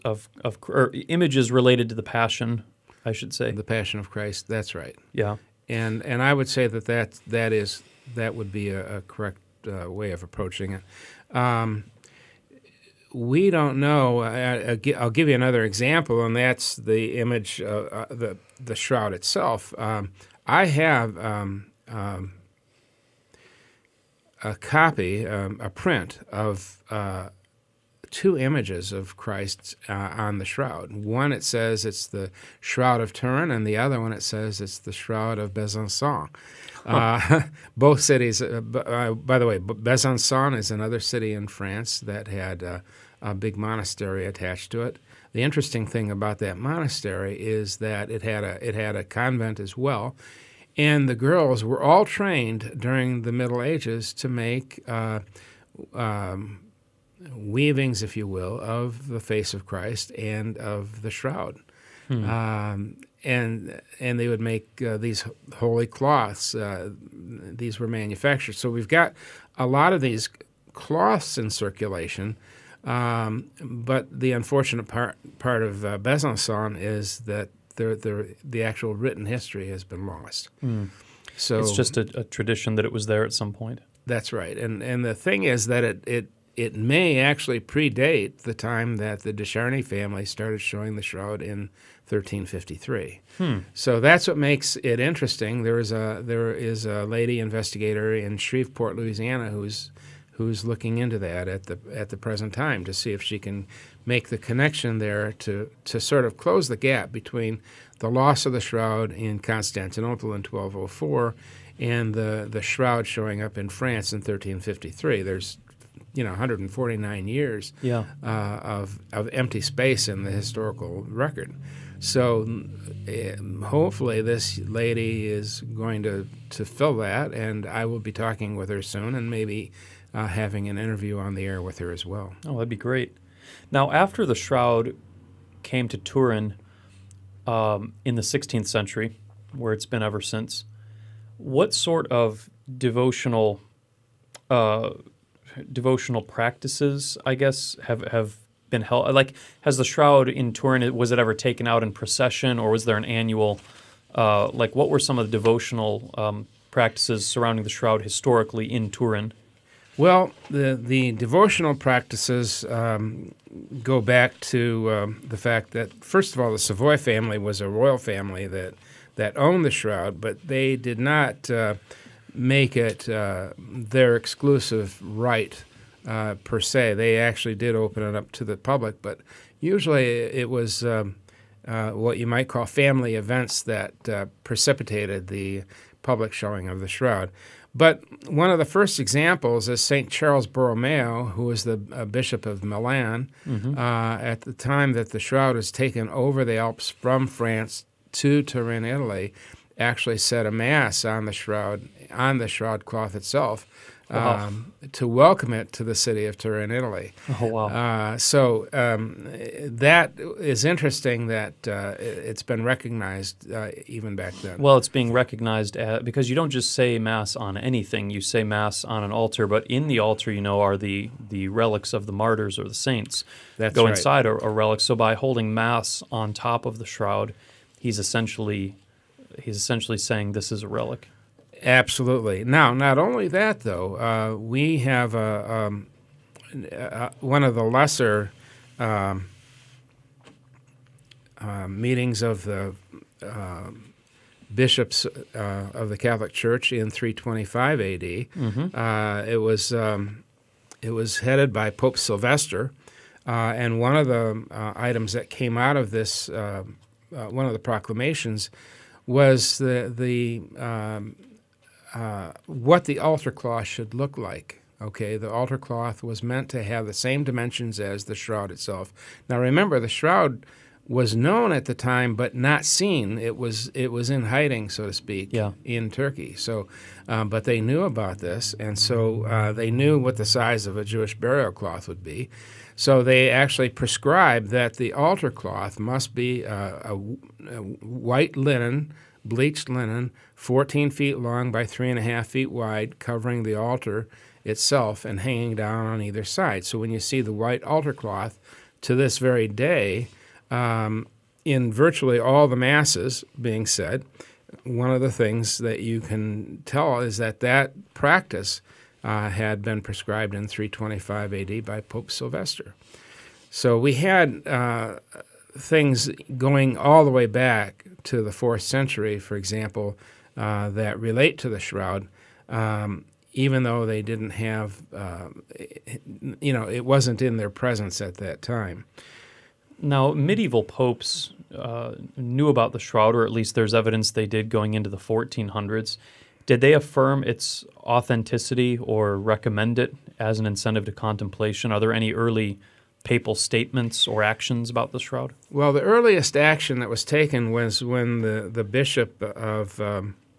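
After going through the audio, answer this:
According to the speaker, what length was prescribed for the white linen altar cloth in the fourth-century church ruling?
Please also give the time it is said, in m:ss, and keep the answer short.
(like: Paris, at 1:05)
14 feet, at 4:50.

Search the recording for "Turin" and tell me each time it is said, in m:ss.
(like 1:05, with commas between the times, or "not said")
0:33, 2:15, 2:30, 2:38, 3:18, 3:26.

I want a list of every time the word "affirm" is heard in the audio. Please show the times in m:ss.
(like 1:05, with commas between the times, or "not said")
5:36.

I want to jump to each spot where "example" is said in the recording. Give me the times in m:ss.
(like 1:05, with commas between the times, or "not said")
0:15, 3:08, 5:19.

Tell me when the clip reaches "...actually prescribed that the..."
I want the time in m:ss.
4:43.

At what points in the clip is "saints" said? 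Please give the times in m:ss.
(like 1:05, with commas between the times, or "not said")
3:42.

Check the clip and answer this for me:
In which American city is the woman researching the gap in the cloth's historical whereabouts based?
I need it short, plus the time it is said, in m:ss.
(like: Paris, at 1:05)
Shreveport, Louisiana, at 1:38.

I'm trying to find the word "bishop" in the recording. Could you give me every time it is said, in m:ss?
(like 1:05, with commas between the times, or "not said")
3:12, 4:04, 5:48.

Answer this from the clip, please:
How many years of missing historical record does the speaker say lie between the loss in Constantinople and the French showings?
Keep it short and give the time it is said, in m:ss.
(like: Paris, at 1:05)
149, at 1:56.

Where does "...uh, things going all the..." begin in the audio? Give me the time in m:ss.
5:14.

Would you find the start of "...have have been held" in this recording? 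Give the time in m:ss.
2:27.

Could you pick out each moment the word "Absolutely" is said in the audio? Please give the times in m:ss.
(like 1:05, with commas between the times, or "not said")
3:51.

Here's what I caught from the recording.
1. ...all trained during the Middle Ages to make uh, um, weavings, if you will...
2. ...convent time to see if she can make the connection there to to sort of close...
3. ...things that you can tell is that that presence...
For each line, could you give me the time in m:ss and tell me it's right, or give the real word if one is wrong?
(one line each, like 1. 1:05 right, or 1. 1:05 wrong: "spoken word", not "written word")
1. 0:51 right
2. 1:42 wrong: "present", not "convent"
3. 5:05 wrong: "practice", not "presence".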